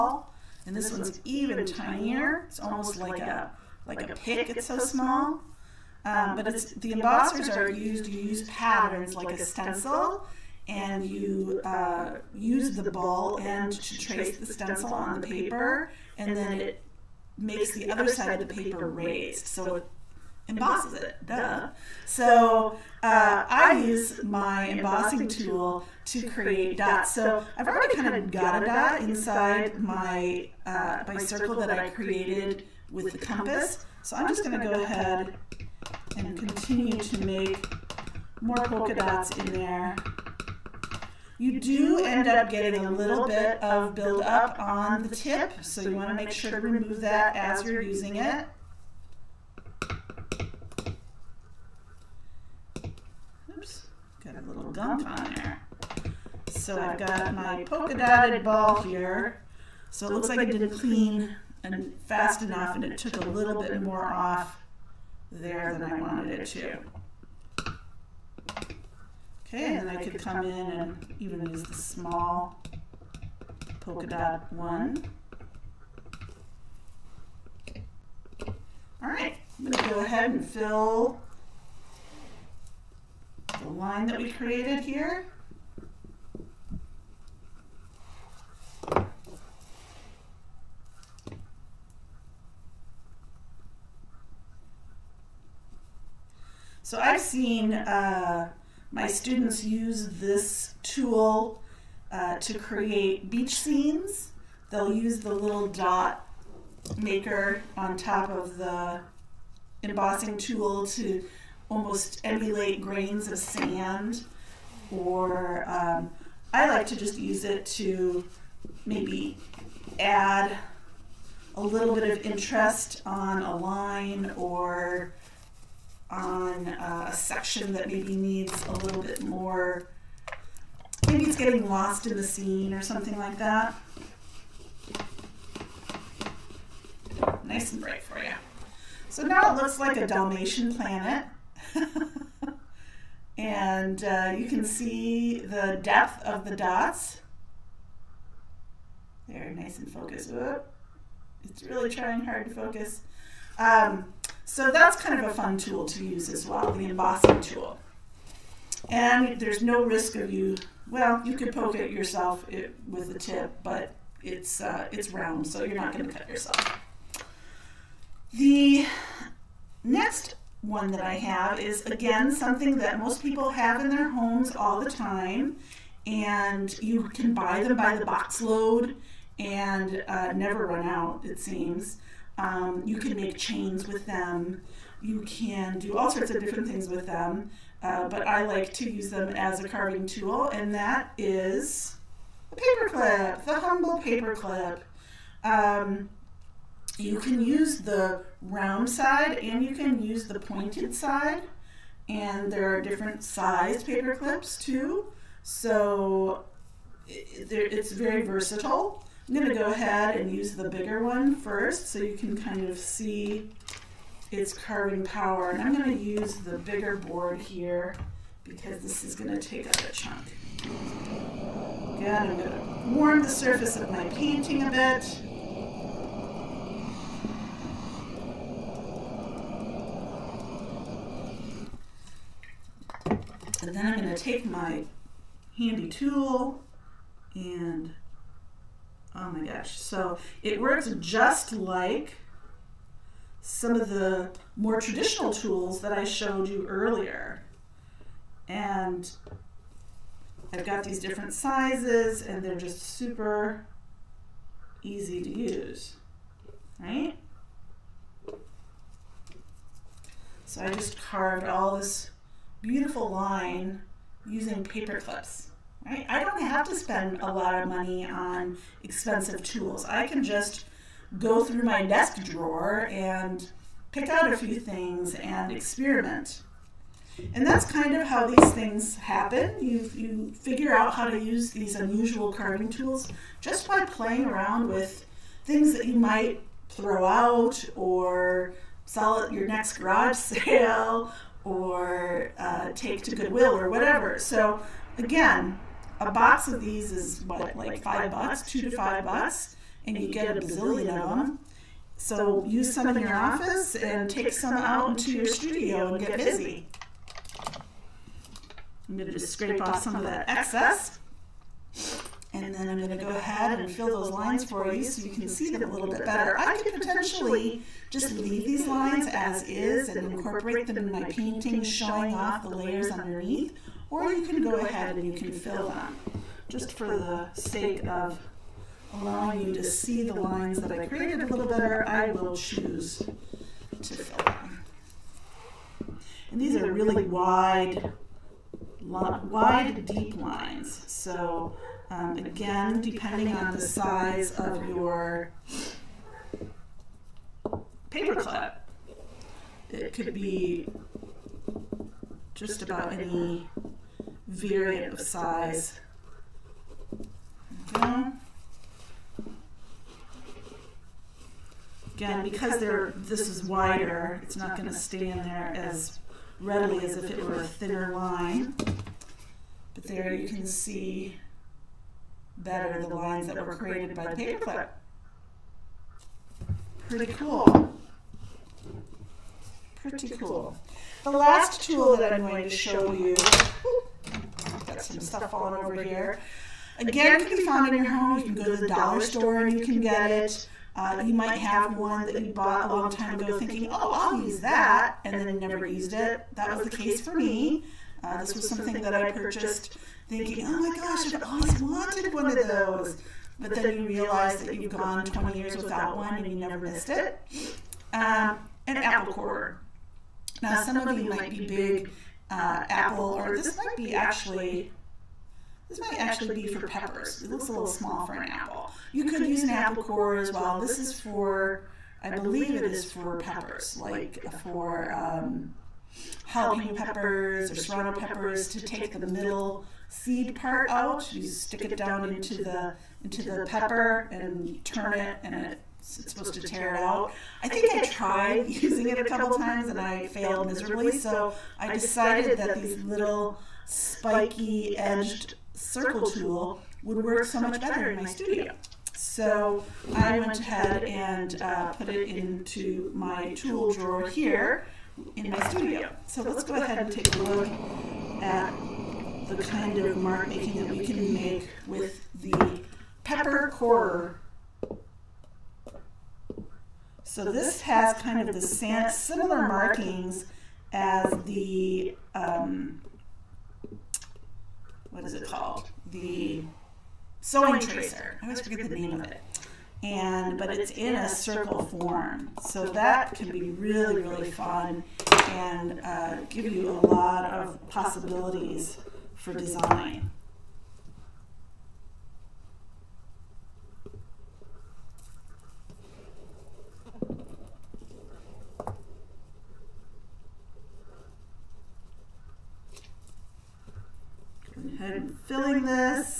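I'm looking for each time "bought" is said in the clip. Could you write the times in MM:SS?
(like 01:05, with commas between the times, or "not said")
06:32.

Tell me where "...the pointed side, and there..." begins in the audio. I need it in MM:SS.
03:20.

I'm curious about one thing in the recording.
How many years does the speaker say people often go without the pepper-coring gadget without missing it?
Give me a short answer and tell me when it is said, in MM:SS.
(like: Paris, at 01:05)
20, at 06:45.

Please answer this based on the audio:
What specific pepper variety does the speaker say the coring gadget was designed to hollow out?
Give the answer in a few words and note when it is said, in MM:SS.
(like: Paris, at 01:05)
jalapeno, at 07:06.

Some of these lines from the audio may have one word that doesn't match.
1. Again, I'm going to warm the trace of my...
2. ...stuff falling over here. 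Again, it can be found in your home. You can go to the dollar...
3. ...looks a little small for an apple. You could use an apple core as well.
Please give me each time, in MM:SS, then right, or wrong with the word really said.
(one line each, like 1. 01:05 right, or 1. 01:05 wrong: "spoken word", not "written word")
1. 03:41 wrong: "surface", not "trace"
2. 06:24 right
3. 06:57 right.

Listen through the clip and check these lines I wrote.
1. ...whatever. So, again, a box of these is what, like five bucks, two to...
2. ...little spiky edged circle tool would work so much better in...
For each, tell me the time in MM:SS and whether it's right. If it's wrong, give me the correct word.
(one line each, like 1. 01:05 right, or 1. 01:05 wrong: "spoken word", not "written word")
1. 04:53 right
2. 07:22 right.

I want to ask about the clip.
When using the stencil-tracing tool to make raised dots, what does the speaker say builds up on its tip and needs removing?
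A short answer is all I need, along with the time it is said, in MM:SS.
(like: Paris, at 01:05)
gunk, at 00:54.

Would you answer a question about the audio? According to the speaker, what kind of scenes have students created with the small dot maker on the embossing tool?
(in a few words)
beach scenes.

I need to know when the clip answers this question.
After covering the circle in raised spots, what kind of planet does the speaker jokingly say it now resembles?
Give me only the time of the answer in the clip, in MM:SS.
02:20.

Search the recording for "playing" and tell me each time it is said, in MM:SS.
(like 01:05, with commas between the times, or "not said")
04:43.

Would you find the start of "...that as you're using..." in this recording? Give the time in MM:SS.
00:47.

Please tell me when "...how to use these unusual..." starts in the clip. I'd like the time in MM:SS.
04:40.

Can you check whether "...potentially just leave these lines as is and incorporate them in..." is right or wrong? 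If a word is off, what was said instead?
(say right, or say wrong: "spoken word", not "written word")
right.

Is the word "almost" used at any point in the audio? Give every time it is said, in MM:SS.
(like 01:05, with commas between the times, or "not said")
00:02, 01:51.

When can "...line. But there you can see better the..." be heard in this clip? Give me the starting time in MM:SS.
06:07.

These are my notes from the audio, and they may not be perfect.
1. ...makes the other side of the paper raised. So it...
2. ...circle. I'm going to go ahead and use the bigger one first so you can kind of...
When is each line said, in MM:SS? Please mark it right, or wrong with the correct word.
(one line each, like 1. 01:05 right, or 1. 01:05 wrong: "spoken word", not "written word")
1. 00:17 right
2. 03:28 wrong: "versatile", not "circle".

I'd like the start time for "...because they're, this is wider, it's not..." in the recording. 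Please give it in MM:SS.
06:02.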